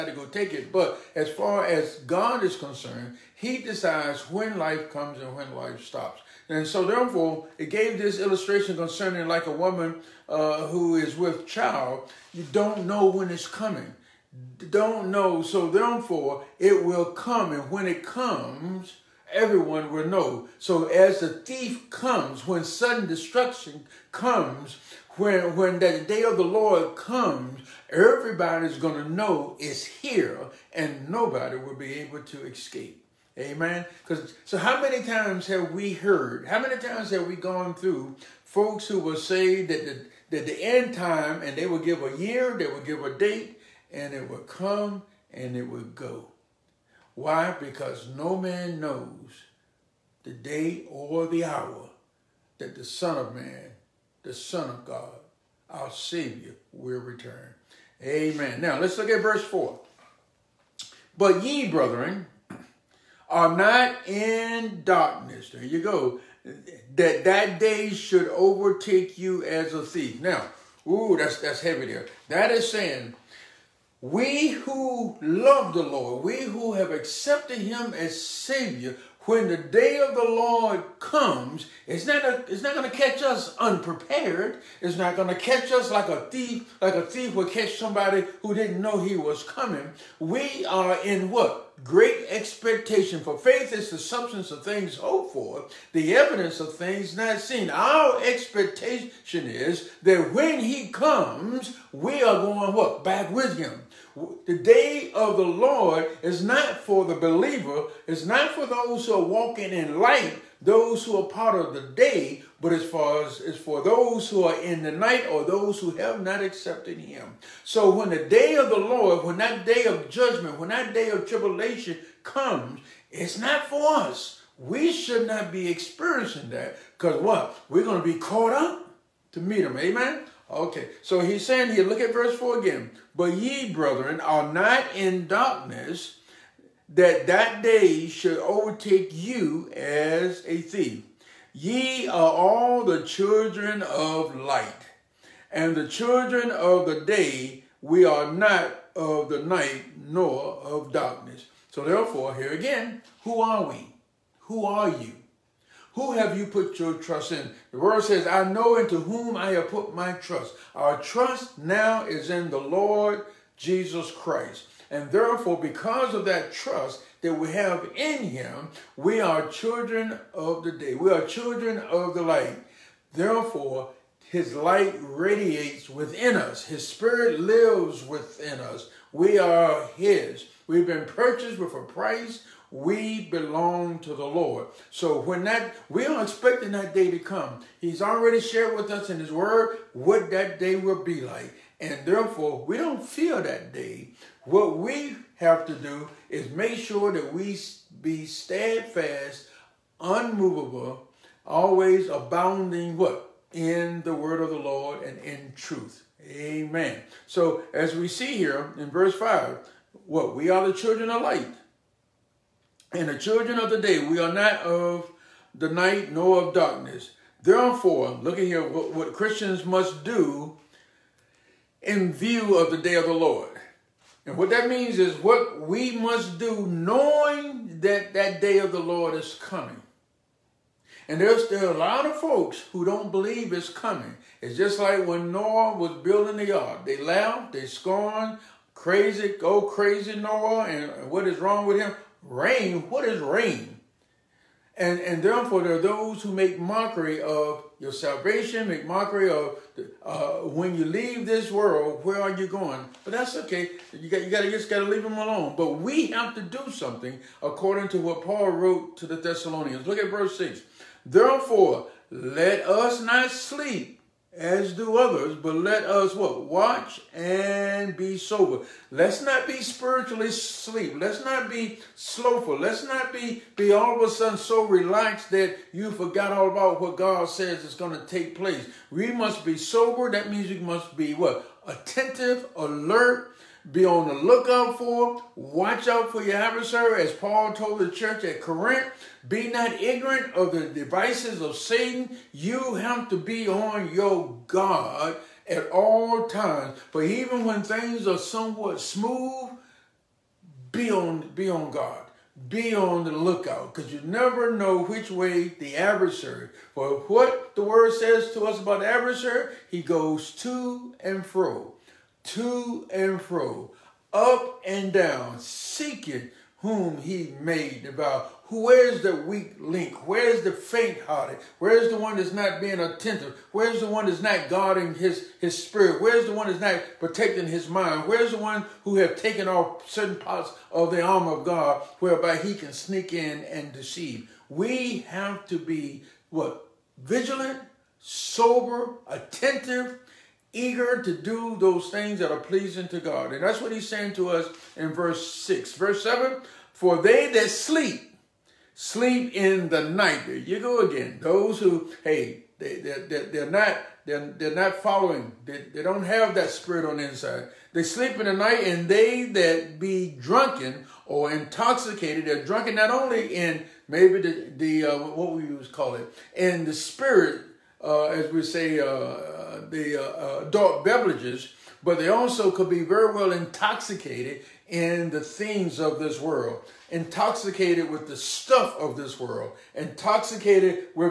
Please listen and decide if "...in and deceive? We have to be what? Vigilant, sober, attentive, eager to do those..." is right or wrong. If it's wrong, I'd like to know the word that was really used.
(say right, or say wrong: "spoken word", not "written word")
right.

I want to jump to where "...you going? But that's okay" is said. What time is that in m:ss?
4:12.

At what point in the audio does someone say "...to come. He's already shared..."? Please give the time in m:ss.
3:07.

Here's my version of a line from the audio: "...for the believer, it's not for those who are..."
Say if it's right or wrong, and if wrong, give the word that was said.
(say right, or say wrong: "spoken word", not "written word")
right.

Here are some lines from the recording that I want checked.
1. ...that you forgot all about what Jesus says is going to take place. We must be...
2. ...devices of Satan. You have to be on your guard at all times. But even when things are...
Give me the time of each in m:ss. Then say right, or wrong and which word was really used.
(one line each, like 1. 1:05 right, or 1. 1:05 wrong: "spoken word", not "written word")
1. 4:35 wrong: "God", not "Jesus"
2. 4:50 right.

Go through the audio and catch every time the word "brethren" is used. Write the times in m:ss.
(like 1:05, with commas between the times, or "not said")
1:01, 2:13.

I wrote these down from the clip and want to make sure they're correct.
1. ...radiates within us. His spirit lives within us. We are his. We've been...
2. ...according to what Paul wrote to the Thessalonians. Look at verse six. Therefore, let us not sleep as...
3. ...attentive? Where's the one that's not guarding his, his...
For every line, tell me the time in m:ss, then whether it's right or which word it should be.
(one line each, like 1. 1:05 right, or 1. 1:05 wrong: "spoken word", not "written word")
1. 2:54 right
2. 4:17 right
3. 5:22 right.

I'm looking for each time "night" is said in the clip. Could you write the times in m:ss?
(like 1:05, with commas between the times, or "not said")
1:54, 2:29, 3:35, 5:49, 5:58.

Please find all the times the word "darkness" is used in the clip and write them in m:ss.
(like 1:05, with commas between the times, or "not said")
1:04, 2:15, 2:30, 3:36.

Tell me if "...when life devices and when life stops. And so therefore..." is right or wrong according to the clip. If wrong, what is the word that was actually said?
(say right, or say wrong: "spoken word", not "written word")
wrong: "comes", not "devices".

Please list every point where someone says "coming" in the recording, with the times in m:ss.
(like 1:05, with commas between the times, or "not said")
0:13, 1:29, 3:49, 3:53.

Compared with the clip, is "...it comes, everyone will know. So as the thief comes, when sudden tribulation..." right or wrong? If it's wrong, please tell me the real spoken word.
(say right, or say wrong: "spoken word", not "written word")
wrong: "destruction", not "tribulation".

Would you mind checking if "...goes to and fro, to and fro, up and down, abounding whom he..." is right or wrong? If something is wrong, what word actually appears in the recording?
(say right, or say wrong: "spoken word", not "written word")
wrong: "seeking", not "abounding".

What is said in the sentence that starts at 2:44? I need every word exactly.
And therefore, because of that trust that we have in him, we are children of the day.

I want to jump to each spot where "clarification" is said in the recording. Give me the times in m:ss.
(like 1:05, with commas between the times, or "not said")
not said.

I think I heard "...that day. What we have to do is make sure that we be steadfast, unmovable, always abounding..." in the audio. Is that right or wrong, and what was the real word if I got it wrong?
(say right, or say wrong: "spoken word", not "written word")
right.